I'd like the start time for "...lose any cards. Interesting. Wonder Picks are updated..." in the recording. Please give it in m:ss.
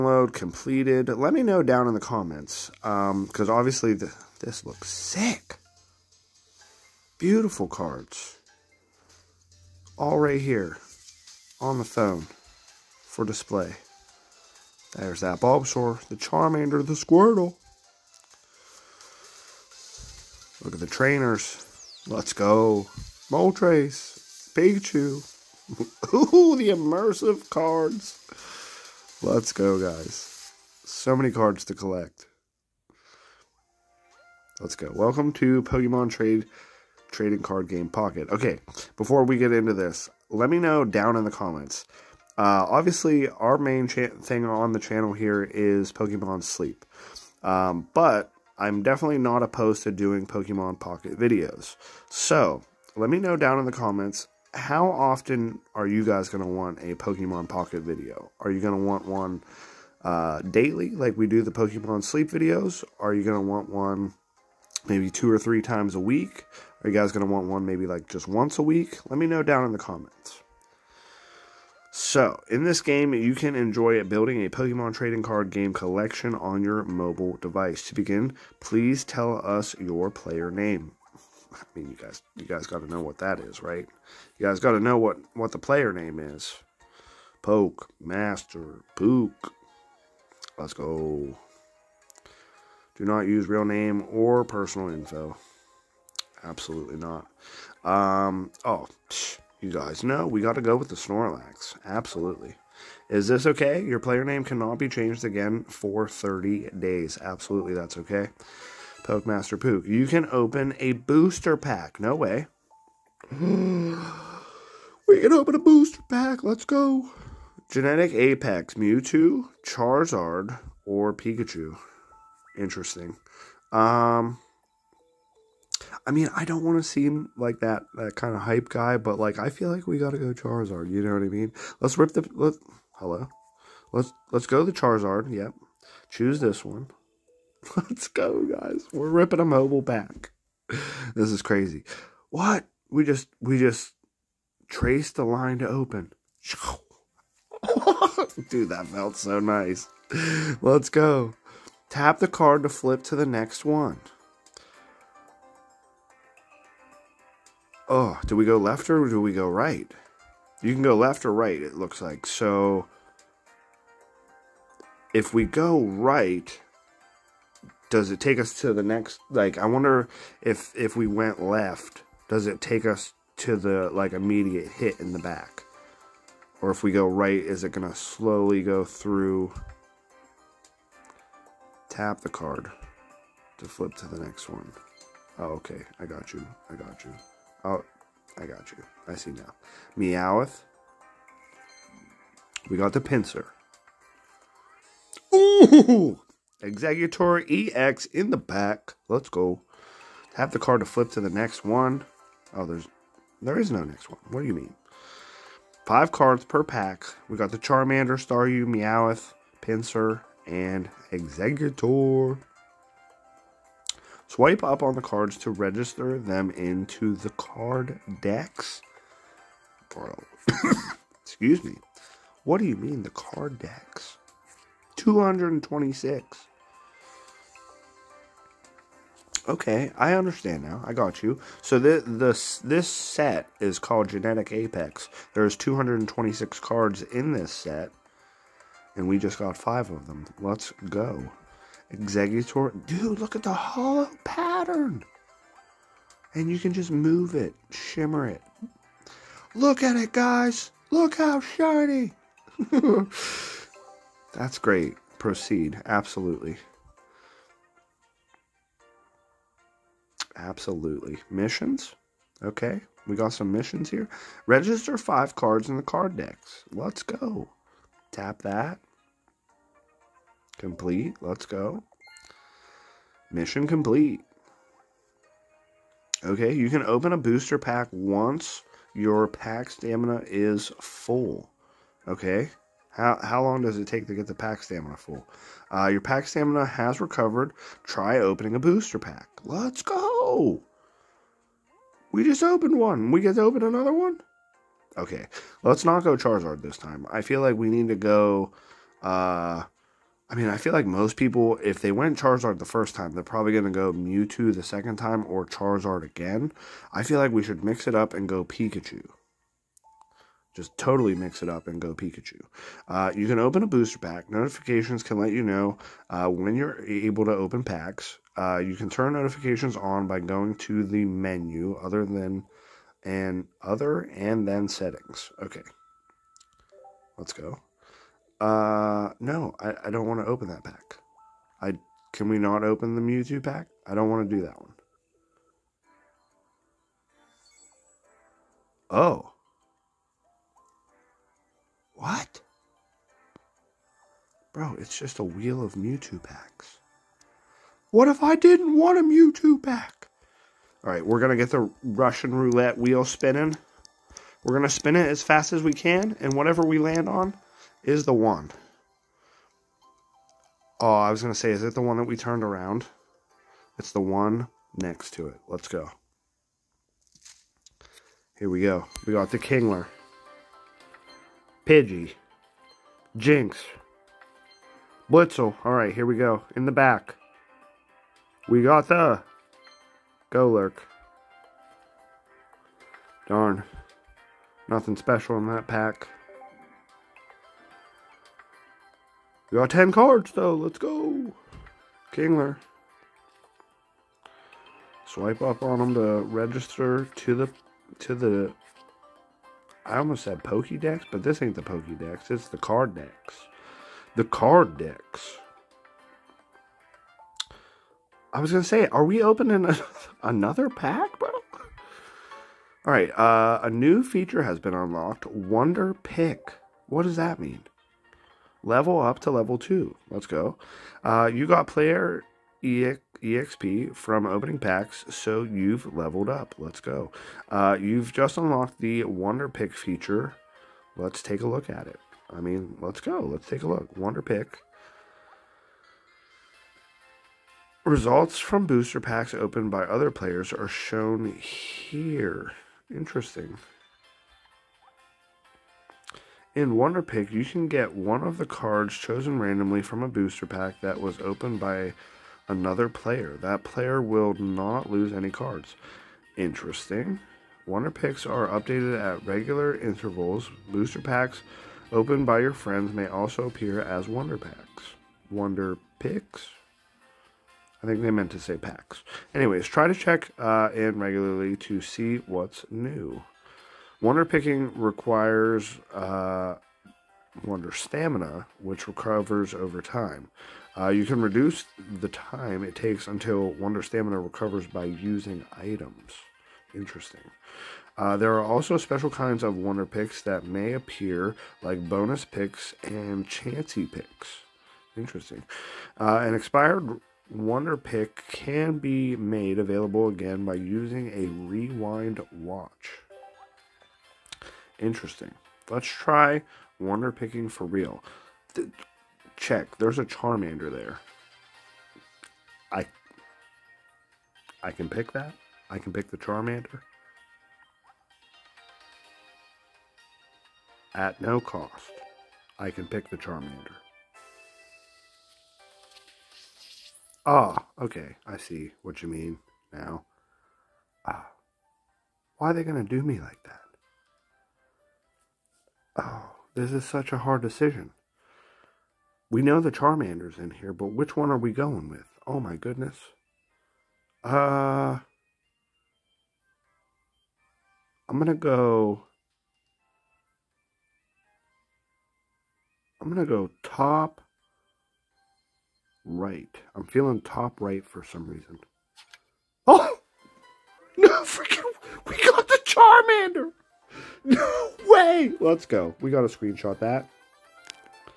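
7:34.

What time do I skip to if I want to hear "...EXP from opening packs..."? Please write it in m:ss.
7:02.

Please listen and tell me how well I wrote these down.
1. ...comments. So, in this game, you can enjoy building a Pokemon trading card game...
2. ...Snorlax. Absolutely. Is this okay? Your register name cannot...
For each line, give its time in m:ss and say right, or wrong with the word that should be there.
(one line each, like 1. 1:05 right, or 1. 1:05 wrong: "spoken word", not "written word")
1. 1:09 right
2. 1:40 wrong: "player", not "register".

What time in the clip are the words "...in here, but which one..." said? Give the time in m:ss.
9:00.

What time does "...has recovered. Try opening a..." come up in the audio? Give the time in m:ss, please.
4:46.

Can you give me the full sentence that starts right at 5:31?
I Can we not open the Mewtwo pack?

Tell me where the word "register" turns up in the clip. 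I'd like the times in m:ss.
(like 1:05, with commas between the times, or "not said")
3:35, 4:24, 6:36.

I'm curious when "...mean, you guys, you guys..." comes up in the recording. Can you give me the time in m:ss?
1:21.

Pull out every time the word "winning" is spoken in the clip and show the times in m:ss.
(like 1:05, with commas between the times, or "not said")
not said.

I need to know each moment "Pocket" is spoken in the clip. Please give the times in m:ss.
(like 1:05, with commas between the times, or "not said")
0:37, 0:50, 0:57.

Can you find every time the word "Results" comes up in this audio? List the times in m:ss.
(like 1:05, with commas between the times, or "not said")
7:17.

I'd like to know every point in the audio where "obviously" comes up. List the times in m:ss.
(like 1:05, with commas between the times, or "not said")
0:03, 0:42.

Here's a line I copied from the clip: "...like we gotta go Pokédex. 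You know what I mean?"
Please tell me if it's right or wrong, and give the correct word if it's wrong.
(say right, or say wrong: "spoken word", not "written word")
wrong: "Charizard", not "Pokédex".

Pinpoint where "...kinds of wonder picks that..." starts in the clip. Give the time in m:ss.
8:09.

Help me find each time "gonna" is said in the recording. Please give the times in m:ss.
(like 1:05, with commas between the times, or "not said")
2:57, 6:48.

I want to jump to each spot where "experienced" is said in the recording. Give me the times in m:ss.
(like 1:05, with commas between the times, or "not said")
not said.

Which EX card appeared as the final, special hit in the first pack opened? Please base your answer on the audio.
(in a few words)
Exeggutor EX.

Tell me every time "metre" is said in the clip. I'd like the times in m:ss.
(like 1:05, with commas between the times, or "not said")
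not said.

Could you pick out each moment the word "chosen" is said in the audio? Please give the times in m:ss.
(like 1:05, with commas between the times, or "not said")
7:28.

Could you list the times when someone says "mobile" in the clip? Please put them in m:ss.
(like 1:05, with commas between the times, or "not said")
1:16, 2:19.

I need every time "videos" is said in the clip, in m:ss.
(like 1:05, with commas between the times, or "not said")
0:51, 0:57, 1:02.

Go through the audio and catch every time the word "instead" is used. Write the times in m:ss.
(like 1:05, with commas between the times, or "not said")
not said.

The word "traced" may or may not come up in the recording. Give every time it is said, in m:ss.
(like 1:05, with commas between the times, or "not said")
2:24.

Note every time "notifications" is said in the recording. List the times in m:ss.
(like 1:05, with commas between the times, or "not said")
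5:14, 5:19.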